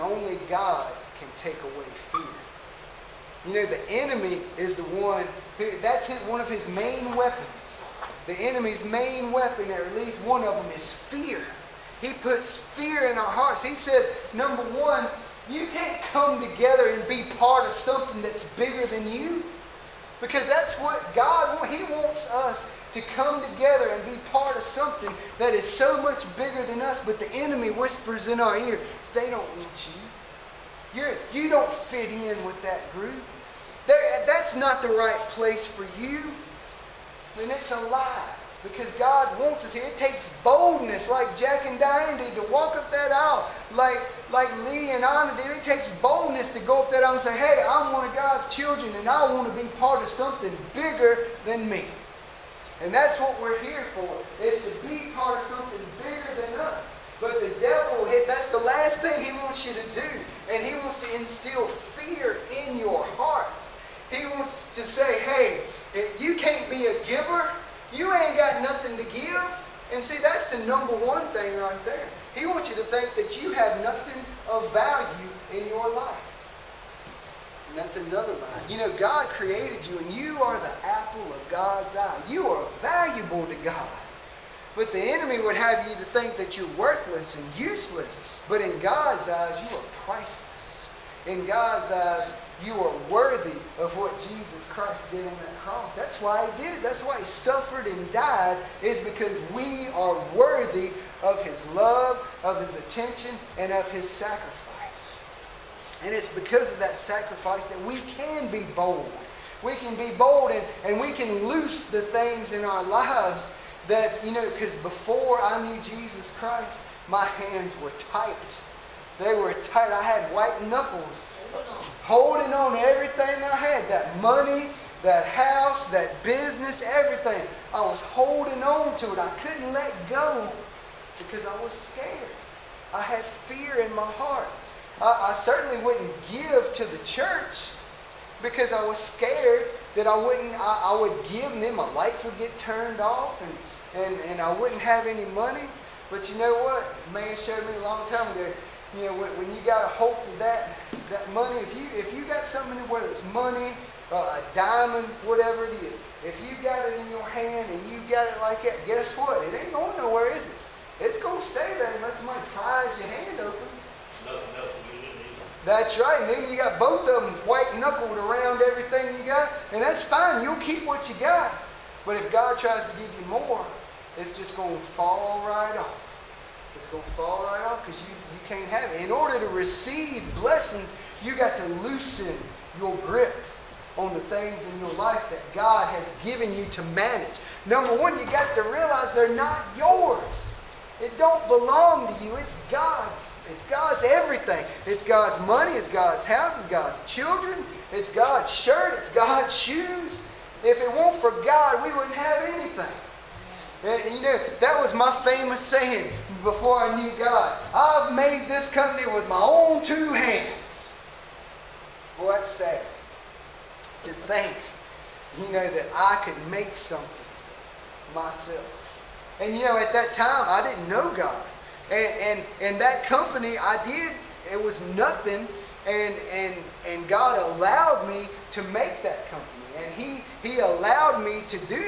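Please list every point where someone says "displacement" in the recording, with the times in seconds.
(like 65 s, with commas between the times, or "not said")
not said.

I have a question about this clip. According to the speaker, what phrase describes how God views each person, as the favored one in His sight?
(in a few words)
apple of God's eye.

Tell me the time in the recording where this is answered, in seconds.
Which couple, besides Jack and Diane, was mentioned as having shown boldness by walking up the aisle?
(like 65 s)
44 s.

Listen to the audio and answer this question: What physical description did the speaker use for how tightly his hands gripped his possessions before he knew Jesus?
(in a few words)
white knuckles.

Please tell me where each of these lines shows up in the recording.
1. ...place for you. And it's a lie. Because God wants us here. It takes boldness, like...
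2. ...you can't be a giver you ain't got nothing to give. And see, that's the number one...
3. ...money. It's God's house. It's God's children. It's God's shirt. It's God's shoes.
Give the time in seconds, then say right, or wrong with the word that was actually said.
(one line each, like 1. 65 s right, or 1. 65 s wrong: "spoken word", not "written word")
1. 35 s right
2. 66 s right
3. 195 s right.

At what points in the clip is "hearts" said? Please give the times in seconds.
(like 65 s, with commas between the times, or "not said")
13 s, 63 s, 134 s.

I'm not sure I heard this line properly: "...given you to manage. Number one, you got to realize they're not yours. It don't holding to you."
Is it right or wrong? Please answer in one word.
wrong.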